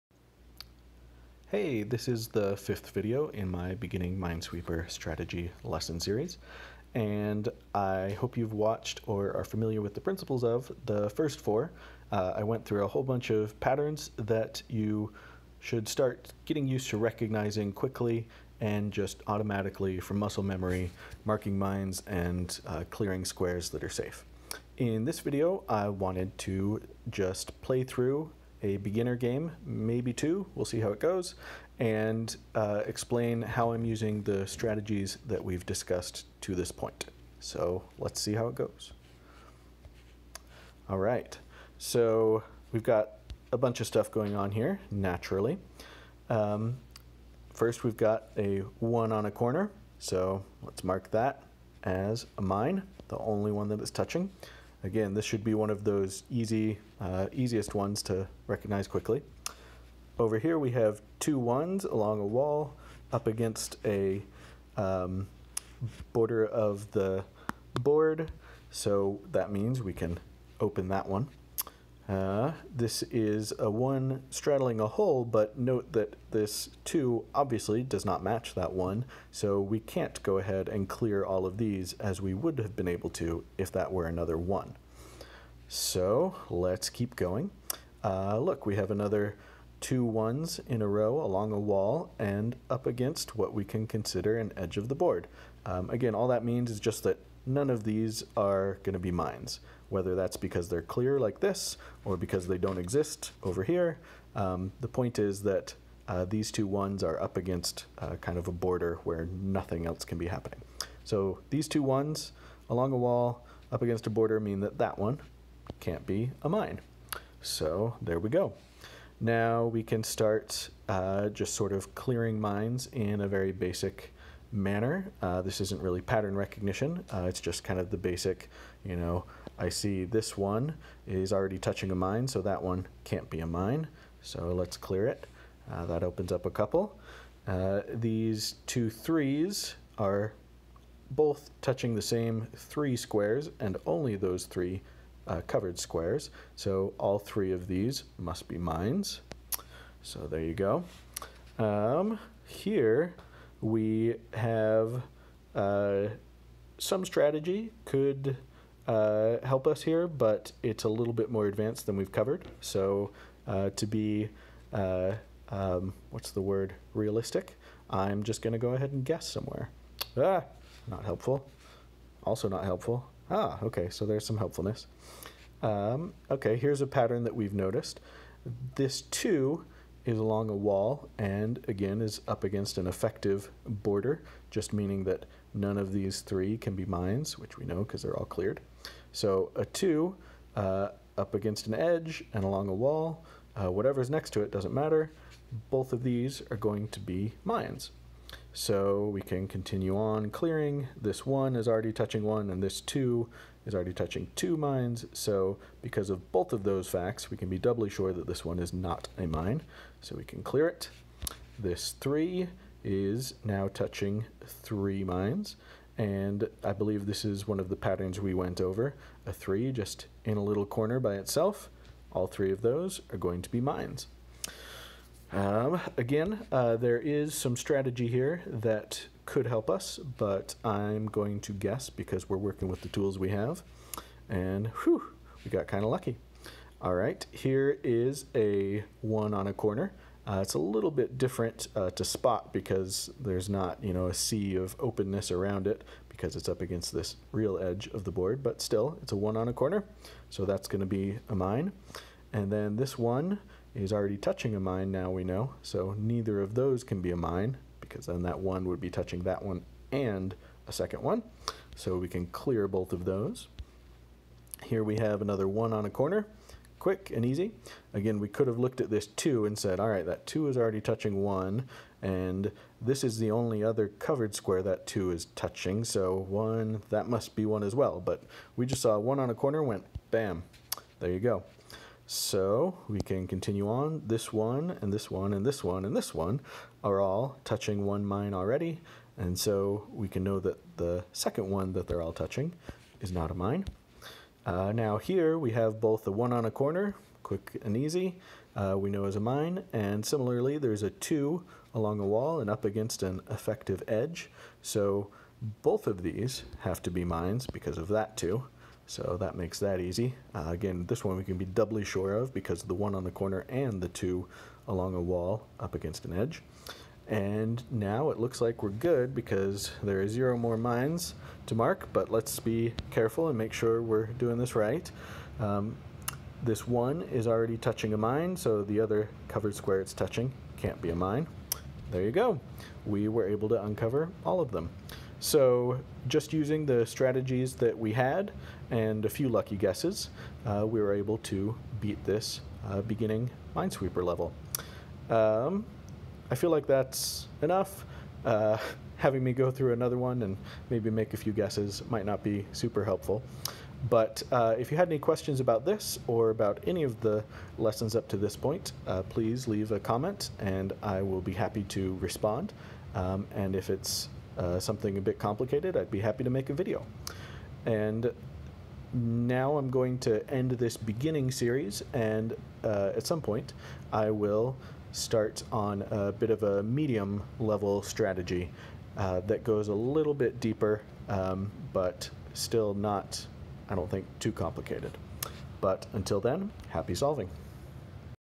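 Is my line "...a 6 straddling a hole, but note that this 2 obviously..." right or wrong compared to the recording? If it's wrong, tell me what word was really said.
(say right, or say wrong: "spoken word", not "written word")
wrong: "1", not "6".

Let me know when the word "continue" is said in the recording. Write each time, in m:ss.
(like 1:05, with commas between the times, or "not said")
3:19, 4:43.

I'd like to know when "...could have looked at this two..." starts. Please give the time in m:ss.
4:28.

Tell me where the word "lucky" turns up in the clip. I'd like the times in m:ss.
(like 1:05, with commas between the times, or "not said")
3:55, 5:39.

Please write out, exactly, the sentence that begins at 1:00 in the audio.
Over here we have two ones along a wall up against a um, border of the board.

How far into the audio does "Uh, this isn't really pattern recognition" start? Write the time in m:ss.
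2:05.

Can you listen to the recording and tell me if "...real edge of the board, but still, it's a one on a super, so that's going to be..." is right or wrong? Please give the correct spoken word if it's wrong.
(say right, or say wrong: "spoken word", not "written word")
wrong: "corner", not "super".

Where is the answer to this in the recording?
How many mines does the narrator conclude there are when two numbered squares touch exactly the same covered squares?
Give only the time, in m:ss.
2:26.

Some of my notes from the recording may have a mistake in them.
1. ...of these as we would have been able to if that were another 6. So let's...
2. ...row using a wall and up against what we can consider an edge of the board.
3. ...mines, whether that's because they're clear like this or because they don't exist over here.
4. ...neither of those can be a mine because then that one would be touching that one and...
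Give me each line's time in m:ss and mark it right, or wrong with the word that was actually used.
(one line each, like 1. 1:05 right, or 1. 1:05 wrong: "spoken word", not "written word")
1. 1:21 wrong: "1", not "6"
2. 1:30 wrong: "along", not "using"
3. 1:39 right
4. 4:15 right.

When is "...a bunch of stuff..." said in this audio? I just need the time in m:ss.
0:43.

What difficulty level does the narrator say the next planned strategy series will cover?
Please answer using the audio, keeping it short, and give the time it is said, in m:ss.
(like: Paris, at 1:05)
medium, at 6:16.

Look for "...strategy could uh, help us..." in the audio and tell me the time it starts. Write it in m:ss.
2:37.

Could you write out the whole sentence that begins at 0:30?
We'll see how it goes, and uh, explain how I'm using the strategies that we've discussed to this point.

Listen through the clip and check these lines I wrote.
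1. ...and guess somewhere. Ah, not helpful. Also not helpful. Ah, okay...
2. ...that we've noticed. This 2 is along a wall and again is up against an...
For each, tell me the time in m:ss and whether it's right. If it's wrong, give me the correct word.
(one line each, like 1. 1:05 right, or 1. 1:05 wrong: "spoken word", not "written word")
1. 2:48 right
2. 2:57 right.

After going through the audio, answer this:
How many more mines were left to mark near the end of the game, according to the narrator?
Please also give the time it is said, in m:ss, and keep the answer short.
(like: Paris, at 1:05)
0, at 5:20.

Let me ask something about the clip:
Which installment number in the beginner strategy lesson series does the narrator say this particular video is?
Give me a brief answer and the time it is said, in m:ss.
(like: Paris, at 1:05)
fifth, at 0:02.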